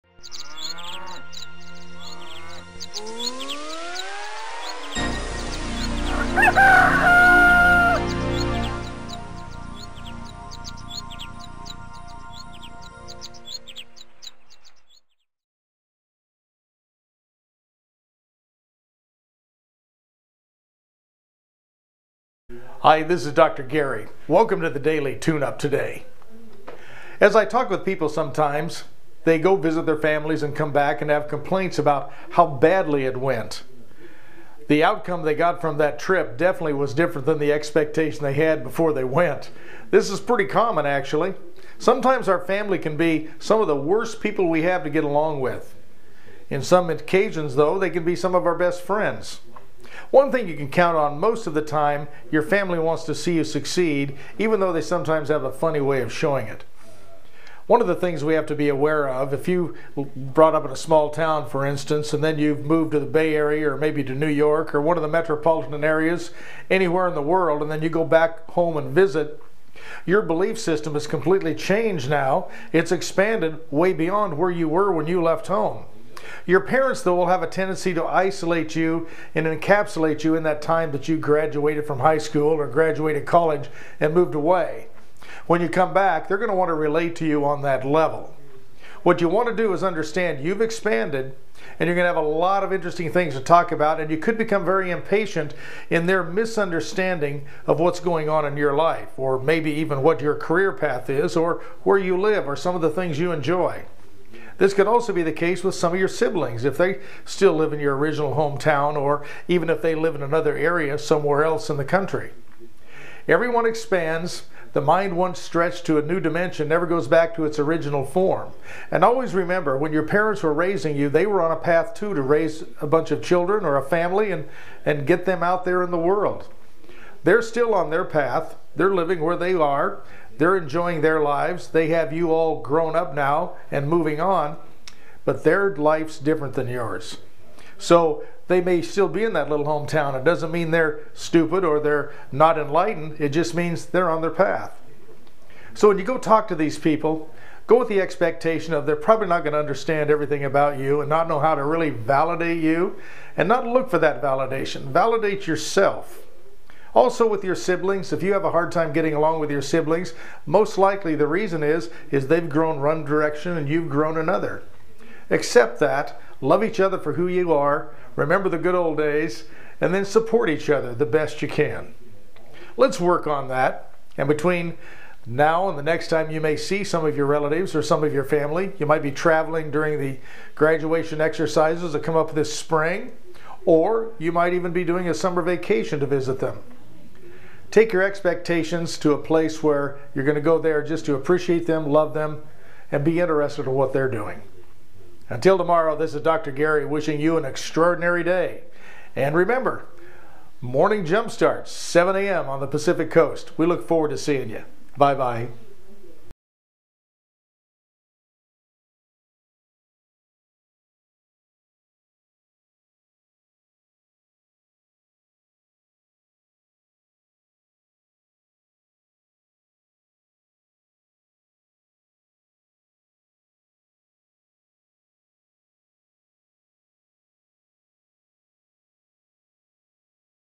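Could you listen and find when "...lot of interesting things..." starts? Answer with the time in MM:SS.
01:32.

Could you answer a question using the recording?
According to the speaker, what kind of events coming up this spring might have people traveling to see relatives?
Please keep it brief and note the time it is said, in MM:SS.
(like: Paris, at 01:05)
graduation exercises, at 03:00.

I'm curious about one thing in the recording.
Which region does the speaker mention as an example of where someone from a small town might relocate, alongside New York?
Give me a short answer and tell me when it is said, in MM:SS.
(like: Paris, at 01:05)
Bay Area, at 01:03.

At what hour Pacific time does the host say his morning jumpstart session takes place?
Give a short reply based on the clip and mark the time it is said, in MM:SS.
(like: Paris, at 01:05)
7 a.m., at 03:21.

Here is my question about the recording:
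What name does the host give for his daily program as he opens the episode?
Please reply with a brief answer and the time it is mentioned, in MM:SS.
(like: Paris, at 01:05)
Daily Tune Up, at 00:24.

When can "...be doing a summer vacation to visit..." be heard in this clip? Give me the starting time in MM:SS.
03:04.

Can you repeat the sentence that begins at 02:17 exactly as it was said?
So they may still be in that little hometown.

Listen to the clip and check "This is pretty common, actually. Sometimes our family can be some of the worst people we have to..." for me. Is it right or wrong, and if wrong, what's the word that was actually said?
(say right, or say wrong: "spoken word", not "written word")
right.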